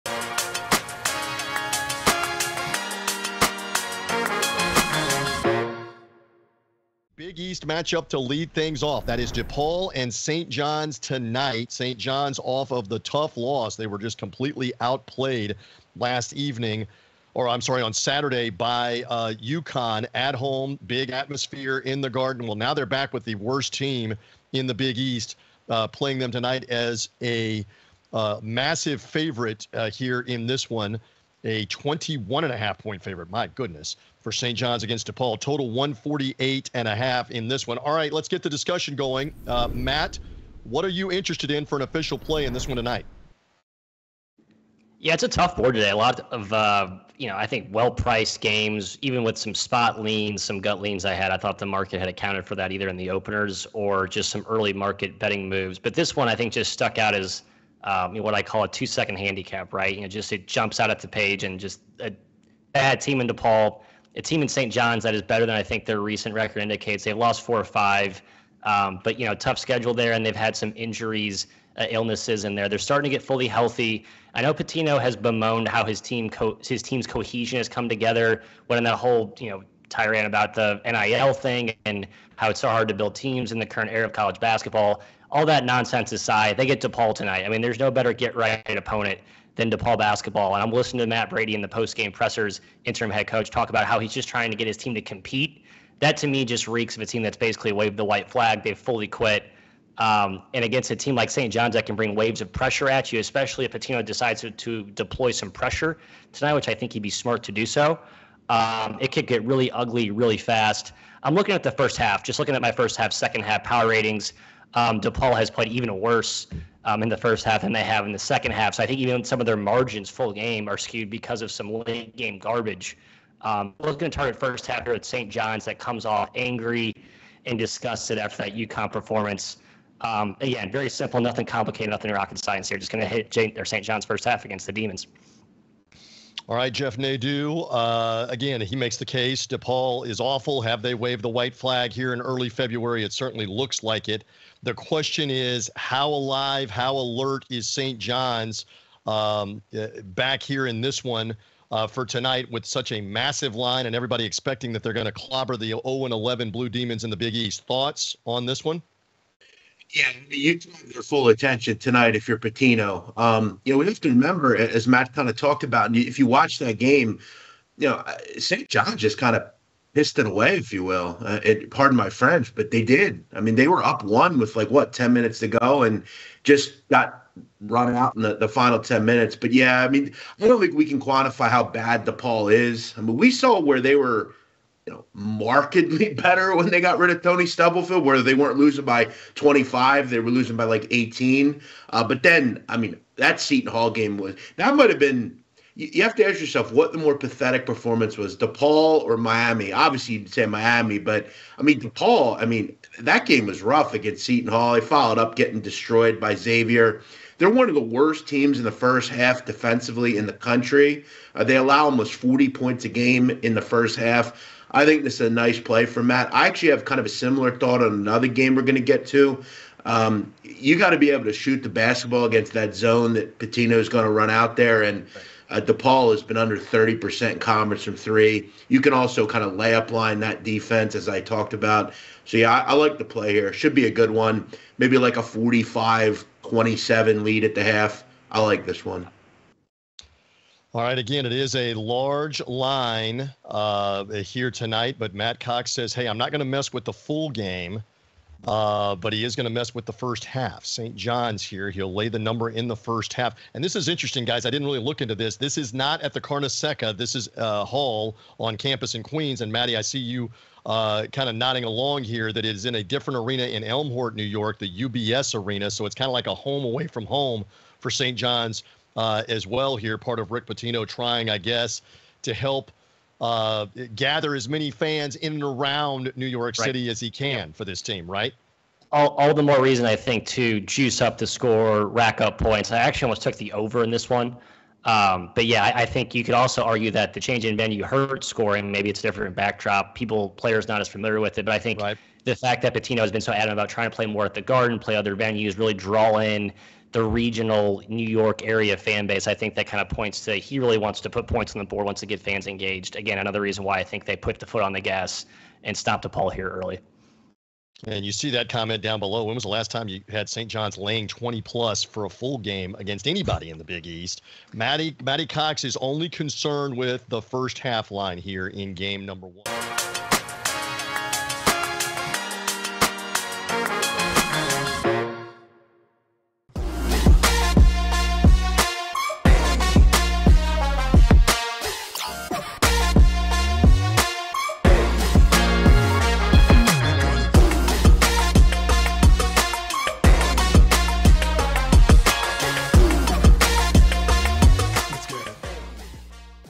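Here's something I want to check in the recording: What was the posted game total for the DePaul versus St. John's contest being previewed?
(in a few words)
148.5.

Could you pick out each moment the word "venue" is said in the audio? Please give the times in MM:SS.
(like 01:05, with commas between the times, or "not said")
04:47, 04:55.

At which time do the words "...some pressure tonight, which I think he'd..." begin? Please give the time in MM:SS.
01:45.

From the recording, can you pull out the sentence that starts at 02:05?
John's that comes off angry and disgusted after that UConn performance.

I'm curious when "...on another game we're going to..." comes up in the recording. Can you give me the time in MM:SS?
03:37.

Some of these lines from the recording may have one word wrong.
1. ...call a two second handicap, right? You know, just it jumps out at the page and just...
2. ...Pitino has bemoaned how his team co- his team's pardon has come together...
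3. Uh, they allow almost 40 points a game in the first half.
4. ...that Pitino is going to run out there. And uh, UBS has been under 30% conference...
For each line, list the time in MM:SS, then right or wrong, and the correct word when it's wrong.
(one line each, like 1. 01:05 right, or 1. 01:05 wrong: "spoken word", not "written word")
1. 00:58 right
2. 01:14 wrong: "cohesion", not "pardon"
3. 03:31 right
4. 03:43 wrong: "DePaul", not "UBS".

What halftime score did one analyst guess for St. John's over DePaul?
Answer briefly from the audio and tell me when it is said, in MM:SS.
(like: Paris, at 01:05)
45-27, at 03:55.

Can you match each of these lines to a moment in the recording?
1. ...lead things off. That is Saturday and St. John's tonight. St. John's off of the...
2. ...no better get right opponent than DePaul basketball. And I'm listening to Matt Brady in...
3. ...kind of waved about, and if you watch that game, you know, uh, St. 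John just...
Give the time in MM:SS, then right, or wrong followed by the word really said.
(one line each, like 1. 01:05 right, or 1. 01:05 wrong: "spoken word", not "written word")
1. 00:08 wrong: "DePaul", not "Saturday"
2. 01:27 right
3. 02:45 wrong: "talked", not "waved".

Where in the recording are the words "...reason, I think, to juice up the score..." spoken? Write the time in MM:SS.
04:39.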